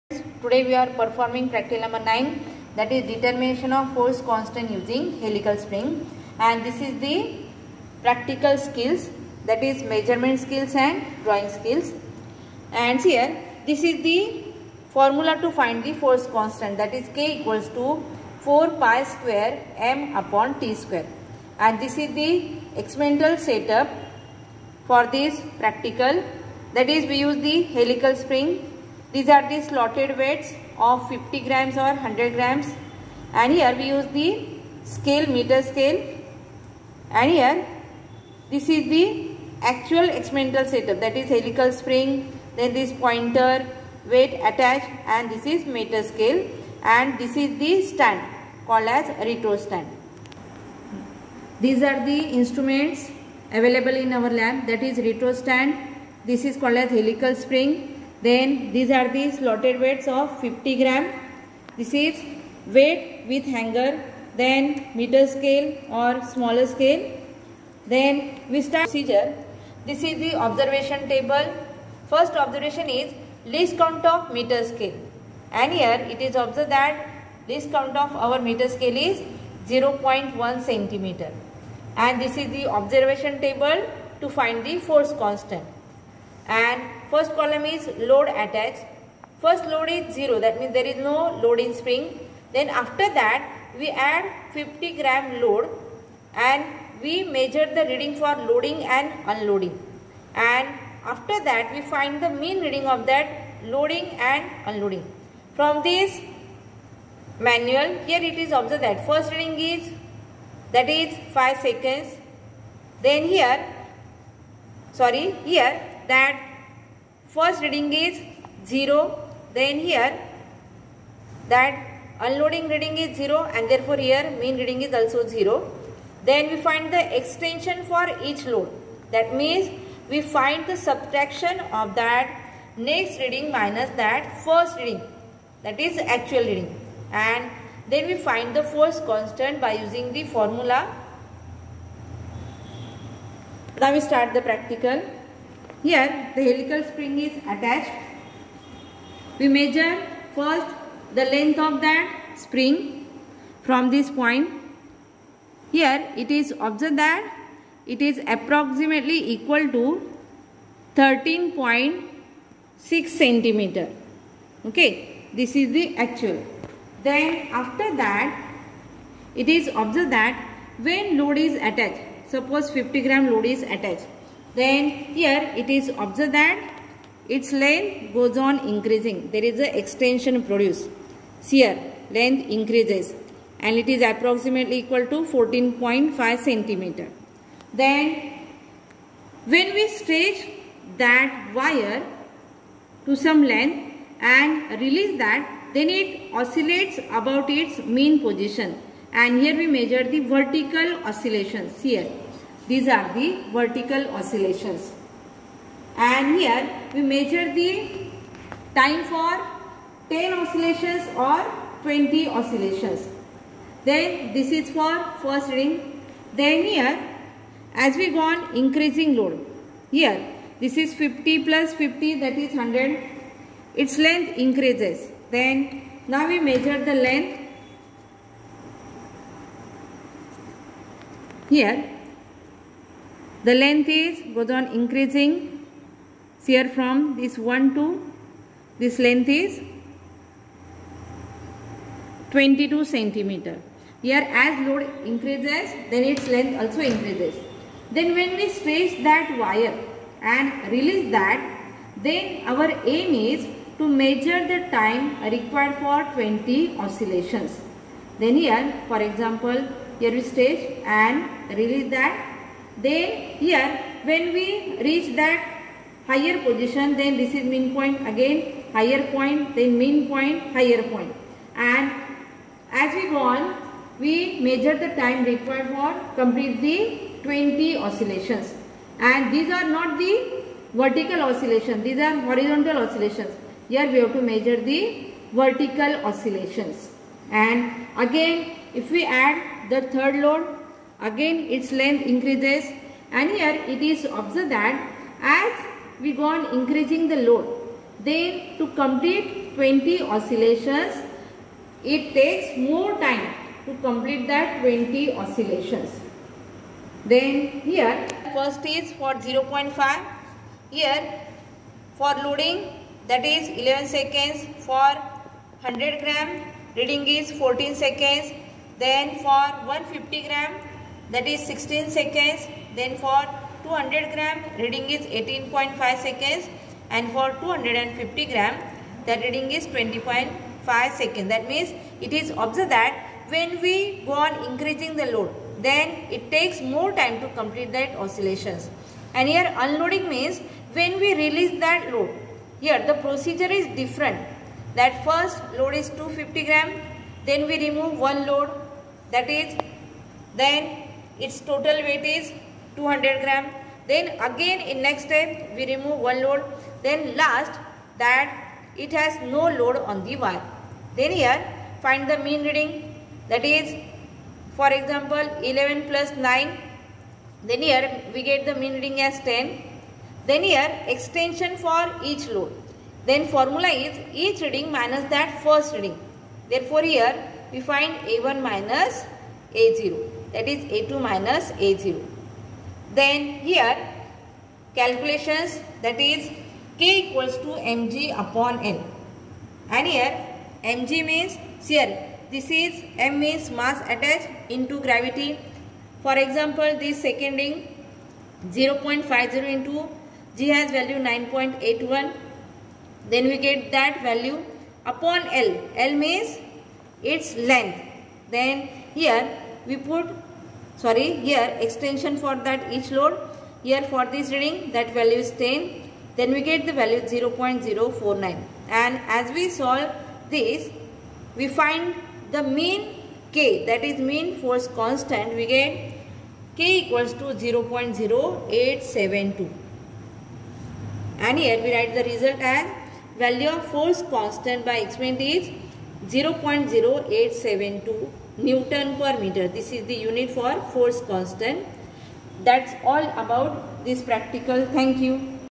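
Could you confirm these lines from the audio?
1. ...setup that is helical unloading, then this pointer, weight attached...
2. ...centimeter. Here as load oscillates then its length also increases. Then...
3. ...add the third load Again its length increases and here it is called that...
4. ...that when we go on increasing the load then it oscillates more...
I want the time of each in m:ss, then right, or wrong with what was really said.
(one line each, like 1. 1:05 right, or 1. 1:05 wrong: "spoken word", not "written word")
1. 0:40 wrong: "spring", not "unloading"
2. 4:02 wrong: "increases", not "oscillates"
3. 4:49 wrong: "observed", not "called"
4. 5:32 wrong: "takes", not "oscillates".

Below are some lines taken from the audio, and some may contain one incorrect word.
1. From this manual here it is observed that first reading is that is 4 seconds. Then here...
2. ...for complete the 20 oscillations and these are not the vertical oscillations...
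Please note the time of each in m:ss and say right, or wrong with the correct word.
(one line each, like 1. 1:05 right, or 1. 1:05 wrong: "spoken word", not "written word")
1. 1:45 wrong: "5", not "4"
2. 4:35 right.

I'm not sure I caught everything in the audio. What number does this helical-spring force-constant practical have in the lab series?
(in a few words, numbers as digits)
9.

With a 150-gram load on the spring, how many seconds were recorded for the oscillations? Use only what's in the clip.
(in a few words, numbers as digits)
16 seconds.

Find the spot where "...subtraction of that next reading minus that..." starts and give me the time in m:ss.
2:10.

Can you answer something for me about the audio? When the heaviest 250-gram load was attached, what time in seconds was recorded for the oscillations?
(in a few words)
20.5 seconds.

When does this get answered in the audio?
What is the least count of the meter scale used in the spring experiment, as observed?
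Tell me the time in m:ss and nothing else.
1:19.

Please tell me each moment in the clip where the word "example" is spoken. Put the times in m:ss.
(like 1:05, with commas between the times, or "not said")
4:19, 6:04, 6:36.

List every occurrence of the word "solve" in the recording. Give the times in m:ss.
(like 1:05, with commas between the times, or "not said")
6:59.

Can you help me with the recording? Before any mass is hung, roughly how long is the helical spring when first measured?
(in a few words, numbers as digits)
13.6 centimeter.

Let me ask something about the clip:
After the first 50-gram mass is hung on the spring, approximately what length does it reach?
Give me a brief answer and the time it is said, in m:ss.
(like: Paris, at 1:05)
14.5 centimeter, at 3:05.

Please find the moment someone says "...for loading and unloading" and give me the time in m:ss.
1:38.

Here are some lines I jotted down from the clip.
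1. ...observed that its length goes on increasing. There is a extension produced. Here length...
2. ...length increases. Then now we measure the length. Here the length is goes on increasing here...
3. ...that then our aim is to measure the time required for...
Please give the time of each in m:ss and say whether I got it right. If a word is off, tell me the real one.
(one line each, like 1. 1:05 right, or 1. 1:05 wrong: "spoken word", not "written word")
1. 2:55 right
2. 3:43 right
3. 4:11 right.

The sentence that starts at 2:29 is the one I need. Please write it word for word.
We measure first the length of that spring from this point.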